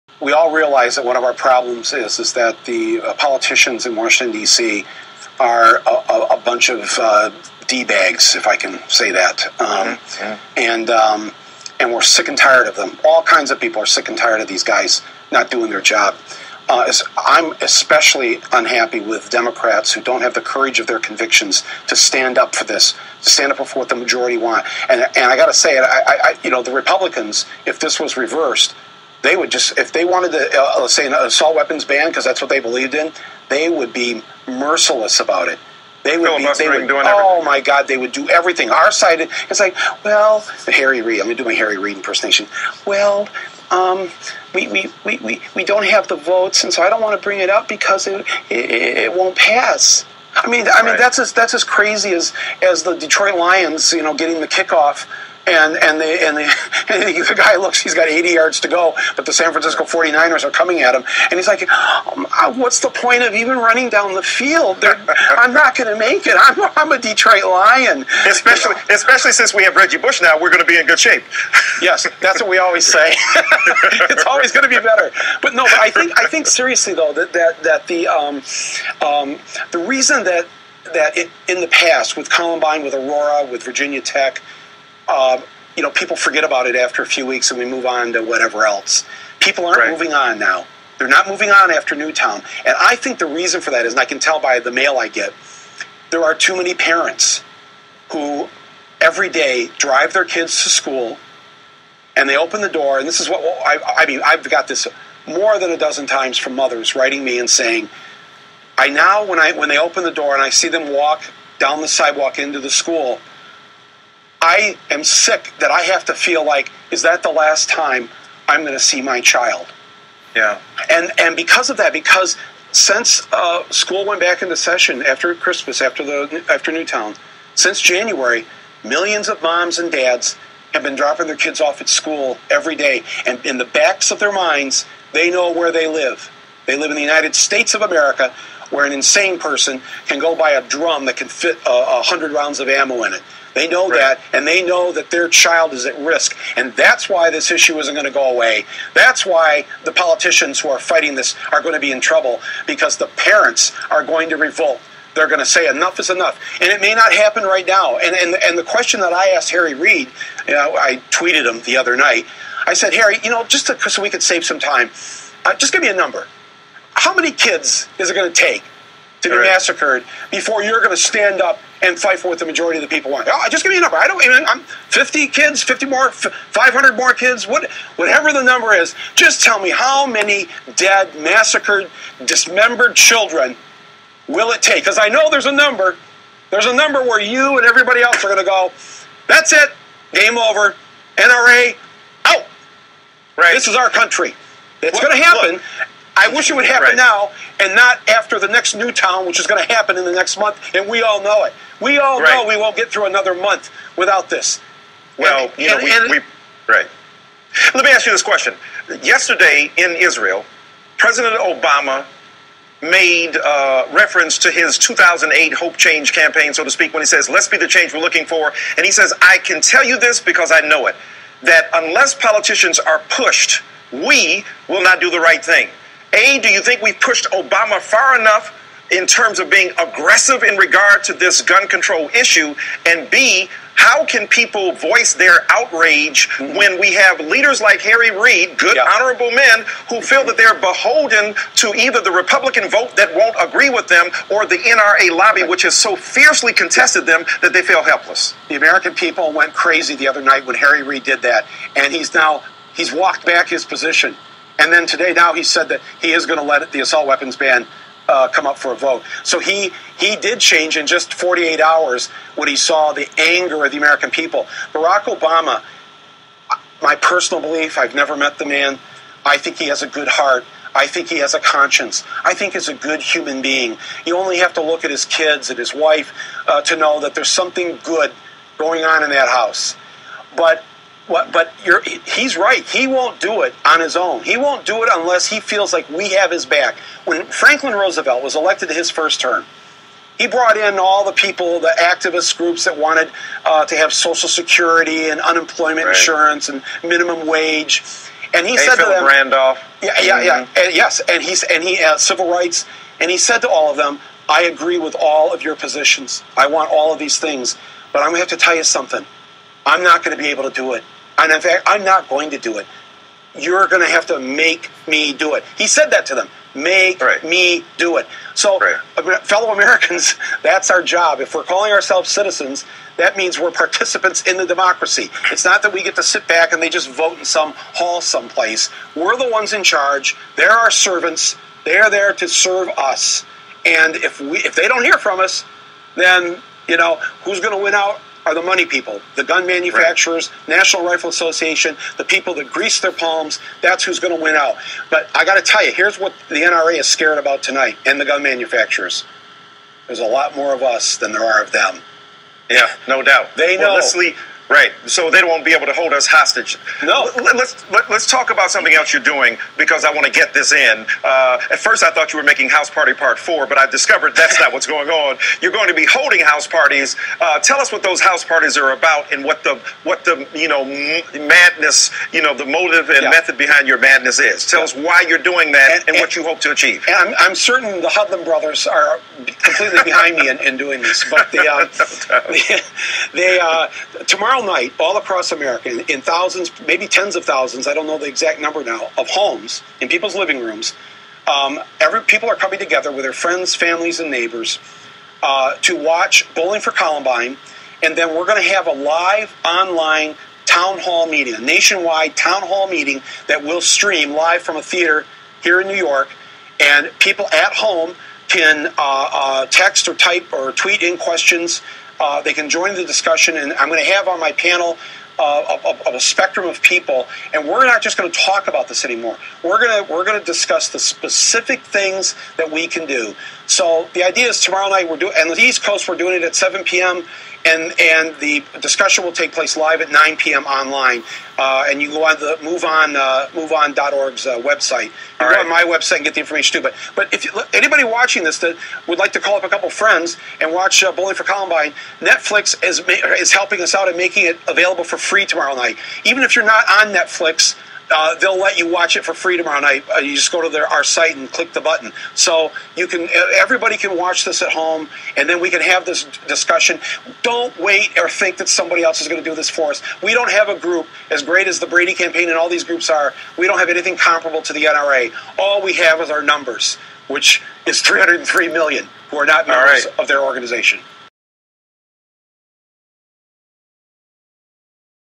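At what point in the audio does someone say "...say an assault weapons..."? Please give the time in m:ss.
0:30.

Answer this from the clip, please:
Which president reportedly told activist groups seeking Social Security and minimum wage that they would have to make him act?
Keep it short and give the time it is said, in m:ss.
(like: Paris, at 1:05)
Franklin Roosevelt, at 4:47.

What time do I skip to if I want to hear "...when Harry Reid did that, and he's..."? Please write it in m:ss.
4:10.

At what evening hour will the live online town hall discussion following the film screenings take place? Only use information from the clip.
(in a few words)
9 p.m.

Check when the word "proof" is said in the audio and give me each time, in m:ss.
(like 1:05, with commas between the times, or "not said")
not said.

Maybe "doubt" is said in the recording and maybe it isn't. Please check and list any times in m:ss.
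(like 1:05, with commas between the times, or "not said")
5:53.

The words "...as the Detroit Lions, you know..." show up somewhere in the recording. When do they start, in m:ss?
0:52.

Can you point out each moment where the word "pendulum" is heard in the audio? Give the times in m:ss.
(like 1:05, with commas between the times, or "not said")
not said.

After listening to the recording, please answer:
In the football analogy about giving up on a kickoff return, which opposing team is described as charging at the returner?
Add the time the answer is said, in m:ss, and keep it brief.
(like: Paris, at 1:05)
San Francisco 49ers, at 0:59.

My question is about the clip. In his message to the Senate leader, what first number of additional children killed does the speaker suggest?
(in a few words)
50.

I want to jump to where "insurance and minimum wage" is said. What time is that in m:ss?
4:55.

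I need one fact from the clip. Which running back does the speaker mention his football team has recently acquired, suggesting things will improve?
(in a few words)
Reggie Bush.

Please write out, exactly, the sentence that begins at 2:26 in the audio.
And that's why this issue isn't going to go away.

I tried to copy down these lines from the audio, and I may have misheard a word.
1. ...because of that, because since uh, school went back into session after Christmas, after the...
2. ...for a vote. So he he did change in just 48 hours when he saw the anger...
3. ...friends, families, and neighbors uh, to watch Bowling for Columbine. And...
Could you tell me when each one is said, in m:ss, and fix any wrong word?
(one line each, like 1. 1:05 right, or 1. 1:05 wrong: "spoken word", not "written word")
1. 2:01 right
2. 4:18 right
3. 6:33 right.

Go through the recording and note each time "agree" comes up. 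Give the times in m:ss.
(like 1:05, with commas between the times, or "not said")
4:03, 5:04.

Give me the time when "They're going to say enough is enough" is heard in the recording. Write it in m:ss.
2:35.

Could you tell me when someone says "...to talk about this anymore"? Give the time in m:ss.
6:58.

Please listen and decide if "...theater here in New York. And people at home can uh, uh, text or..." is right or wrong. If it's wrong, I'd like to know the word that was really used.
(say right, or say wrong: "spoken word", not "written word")
right.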